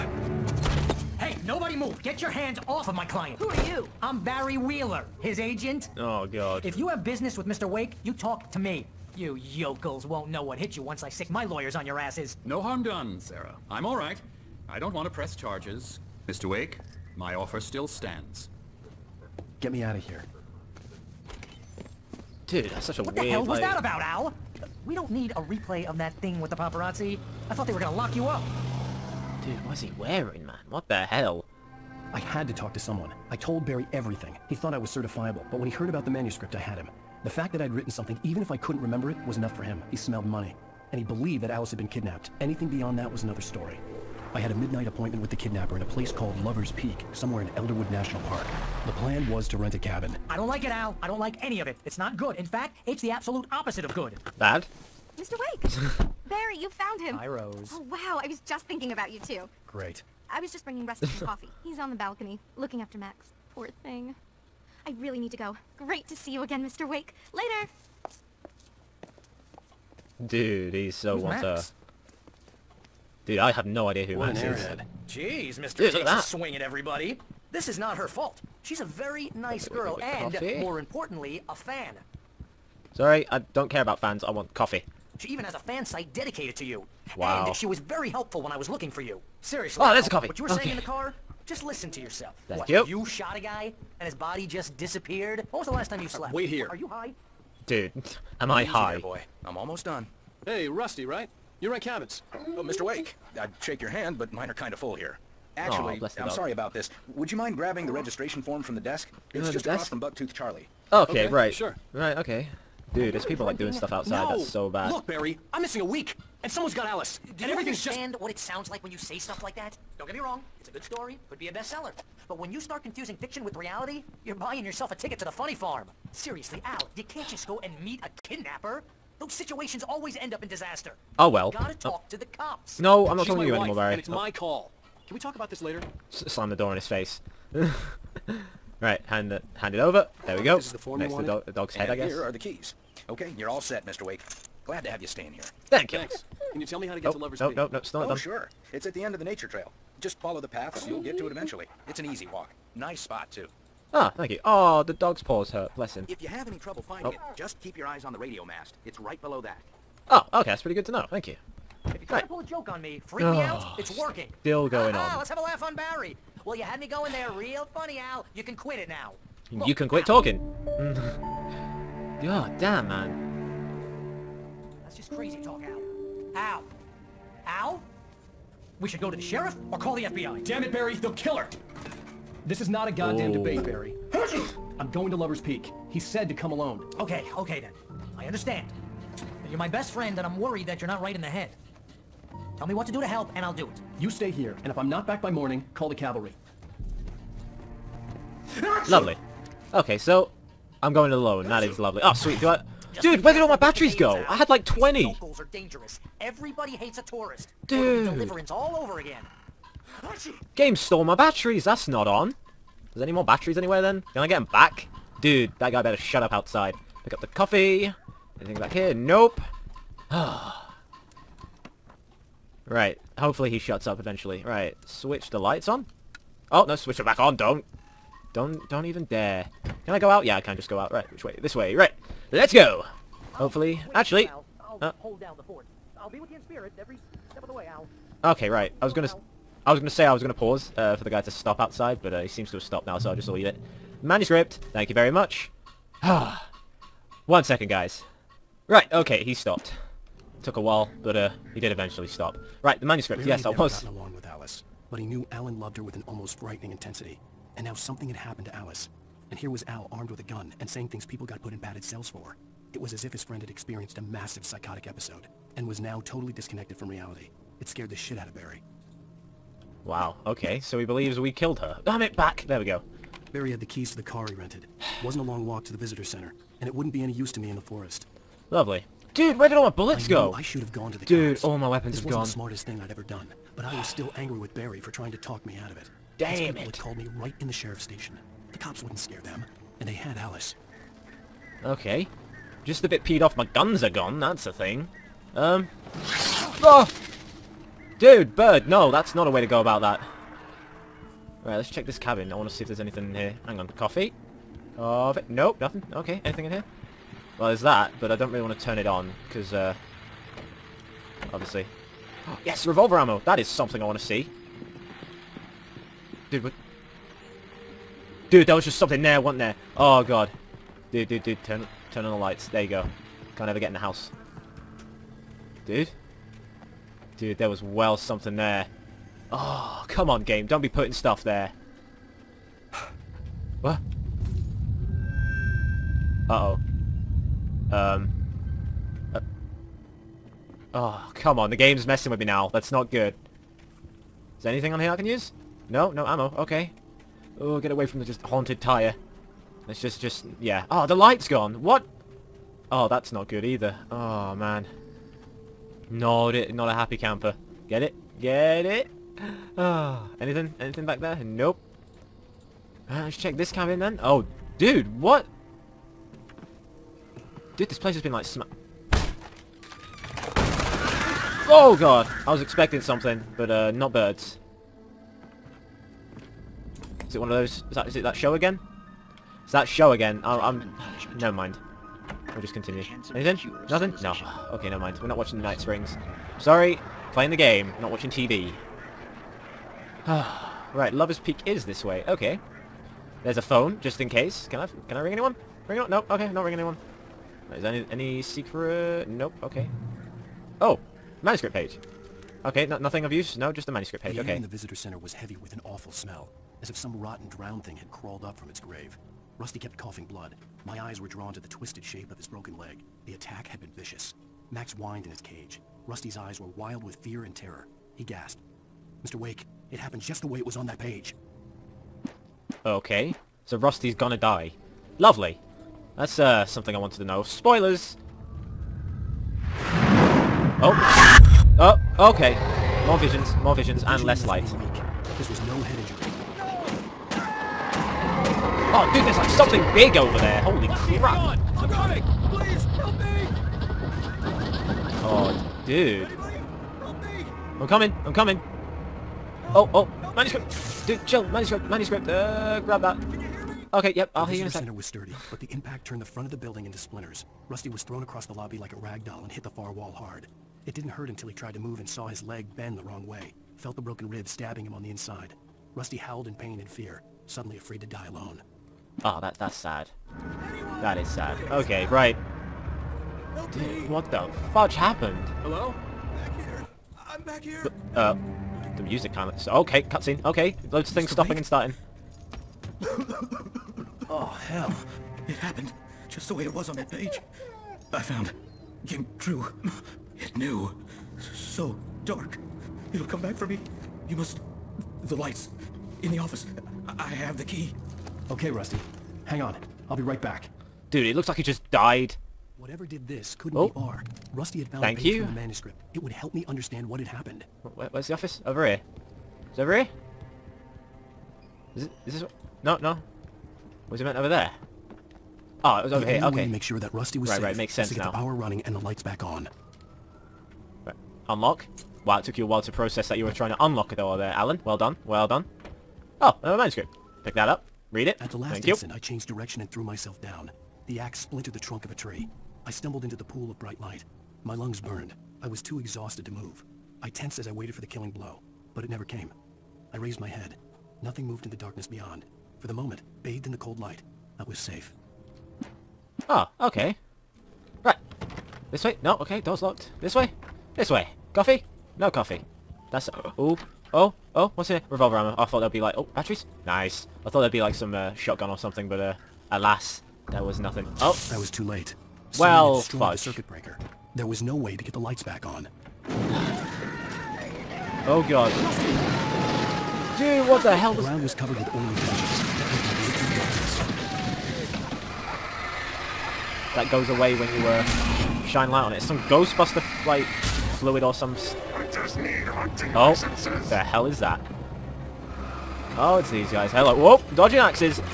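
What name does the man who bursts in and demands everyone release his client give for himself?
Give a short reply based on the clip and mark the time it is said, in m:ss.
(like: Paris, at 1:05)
Barry Wheeler, at 0:04.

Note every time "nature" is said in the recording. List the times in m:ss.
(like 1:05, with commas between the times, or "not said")
2:29.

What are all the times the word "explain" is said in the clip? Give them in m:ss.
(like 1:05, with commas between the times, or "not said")
not said.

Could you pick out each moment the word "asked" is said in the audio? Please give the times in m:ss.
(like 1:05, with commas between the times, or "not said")
not said.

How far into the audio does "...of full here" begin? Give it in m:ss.
1:44.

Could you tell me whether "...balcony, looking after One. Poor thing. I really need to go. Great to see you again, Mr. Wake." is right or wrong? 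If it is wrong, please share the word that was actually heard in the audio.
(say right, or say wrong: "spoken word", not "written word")
wrong: "Max", not "One".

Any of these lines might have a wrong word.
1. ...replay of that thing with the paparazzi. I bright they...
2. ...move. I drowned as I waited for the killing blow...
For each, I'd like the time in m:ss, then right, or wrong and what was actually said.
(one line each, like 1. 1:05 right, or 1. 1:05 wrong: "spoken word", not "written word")
1. 0:25 wrong: "thought", not "bright"
2. 8:56 wrong: "tensed", not "drowned".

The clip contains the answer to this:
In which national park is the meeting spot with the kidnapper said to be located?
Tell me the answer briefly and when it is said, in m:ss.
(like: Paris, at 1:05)
Elderwood National Park, at 0:47.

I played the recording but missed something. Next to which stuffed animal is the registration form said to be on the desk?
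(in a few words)
Bucktooth Charlie.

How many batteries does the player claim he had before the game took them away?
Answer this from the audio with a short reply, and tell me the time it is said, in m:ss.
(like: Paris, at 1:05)
20, at 3:24.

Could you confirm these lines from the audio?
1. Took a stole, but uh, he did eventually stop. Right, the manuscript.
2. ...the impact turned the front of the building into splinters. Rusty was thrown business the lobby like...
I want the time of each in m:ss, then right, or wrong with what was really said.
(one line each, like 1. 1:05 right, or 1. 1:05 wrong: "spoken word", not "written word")
1. 4:10 wrong: "while", not "stole"
2. 7:35 wrong: "across", not "business".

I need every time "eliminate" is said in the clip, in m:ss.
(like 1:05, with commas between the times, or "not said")
not said.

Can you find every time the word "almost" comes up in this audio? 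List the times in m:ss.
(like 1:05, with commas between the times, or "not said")
1:39, 4:16.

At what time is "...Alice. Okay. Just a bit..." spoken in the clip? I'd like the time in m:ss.
4:50.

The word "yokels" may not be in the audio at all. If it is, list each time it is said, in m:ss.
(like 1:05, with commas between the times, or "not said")
0:09.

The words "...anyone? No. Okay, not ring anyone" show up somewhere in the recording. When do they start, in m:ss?
6:35.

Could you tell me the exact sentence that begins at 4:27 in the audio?
It scared the shit out of Barry.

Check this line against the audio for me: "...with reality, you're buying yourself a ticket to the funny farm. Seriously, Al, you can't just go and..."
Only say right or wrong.
right.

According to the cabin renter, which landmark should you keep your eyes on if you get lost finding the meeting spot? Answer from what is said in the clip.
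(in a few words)
radio mast.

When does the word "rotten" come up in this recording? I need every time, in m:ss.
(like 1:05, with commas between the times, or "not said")
6:47.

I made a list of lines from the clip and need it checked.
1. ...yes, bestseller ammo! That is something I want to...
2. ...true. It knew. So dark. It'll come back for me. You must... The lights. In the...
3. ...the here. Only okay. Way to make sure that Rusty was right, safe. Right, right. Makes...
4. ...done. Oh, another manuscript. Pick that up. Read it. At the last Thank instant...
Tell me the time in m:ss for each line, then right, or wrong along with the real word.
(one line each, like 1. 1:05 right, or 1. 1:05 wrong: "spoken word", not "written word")
1. 5:12 wrong: "revolver", not "bestseller"
2. 8:09 right
3. 8:36 right
4. 8:45 right.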